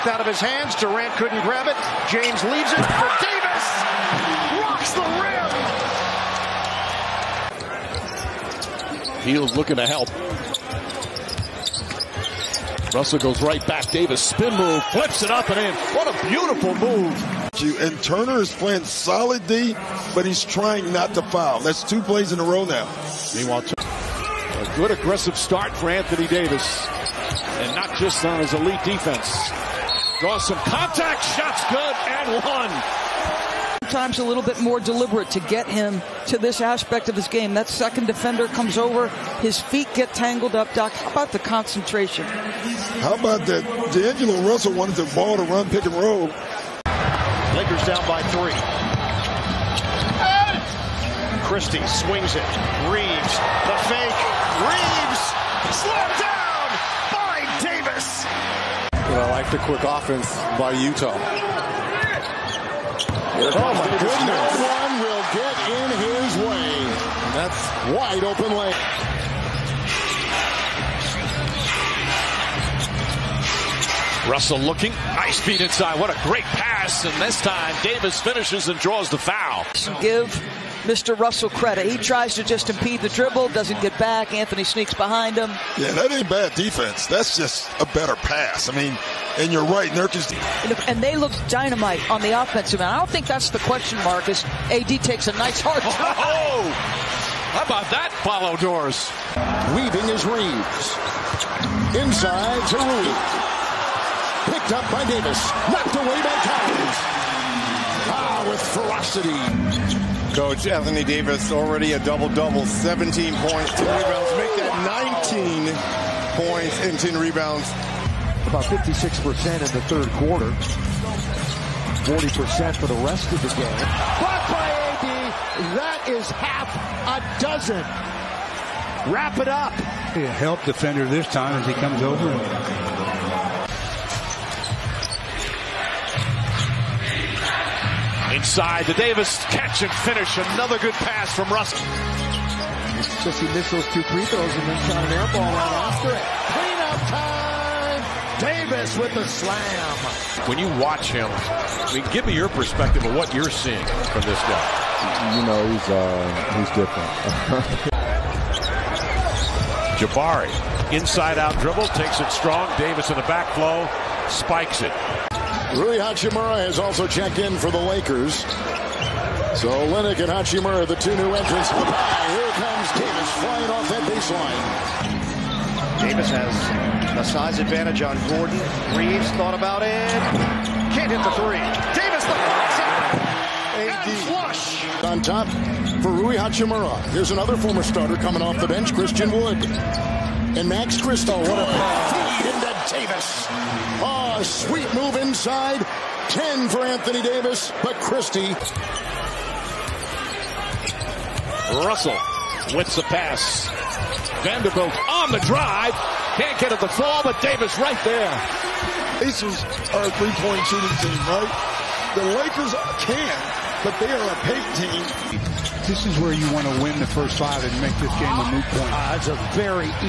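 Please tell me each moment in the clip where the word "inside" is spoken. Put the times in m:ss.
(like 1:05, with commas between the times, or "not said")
1:15, 1:41, 2:18, 2:40, 3:15.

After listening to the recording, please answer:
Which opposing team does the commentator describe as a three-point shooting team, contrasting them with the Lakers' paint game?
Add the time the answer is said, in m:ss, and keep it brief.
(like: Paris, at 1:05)
Pacers, at 3:29.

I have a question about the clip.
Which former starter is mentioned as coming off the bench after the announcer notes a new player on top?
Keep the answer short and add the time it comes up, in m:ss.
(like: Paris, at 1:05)
Christian Wood, at 3:08.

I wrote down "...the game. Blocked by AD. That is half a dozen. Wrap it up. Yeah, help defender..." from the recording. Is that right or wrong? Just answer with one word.
right.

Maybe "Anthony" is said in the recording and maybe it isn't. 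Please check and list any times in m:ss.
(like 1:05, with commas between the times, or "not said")
0:25, 1:24, 1:50, 3:16.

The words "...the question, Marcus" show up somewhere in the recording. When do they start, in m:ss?
1:33.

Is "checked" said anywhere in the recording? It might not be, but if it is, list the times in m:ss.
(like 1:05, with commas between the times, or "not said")
2:47.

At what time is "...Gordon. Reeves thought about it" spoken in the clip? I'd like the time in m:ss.
2:58.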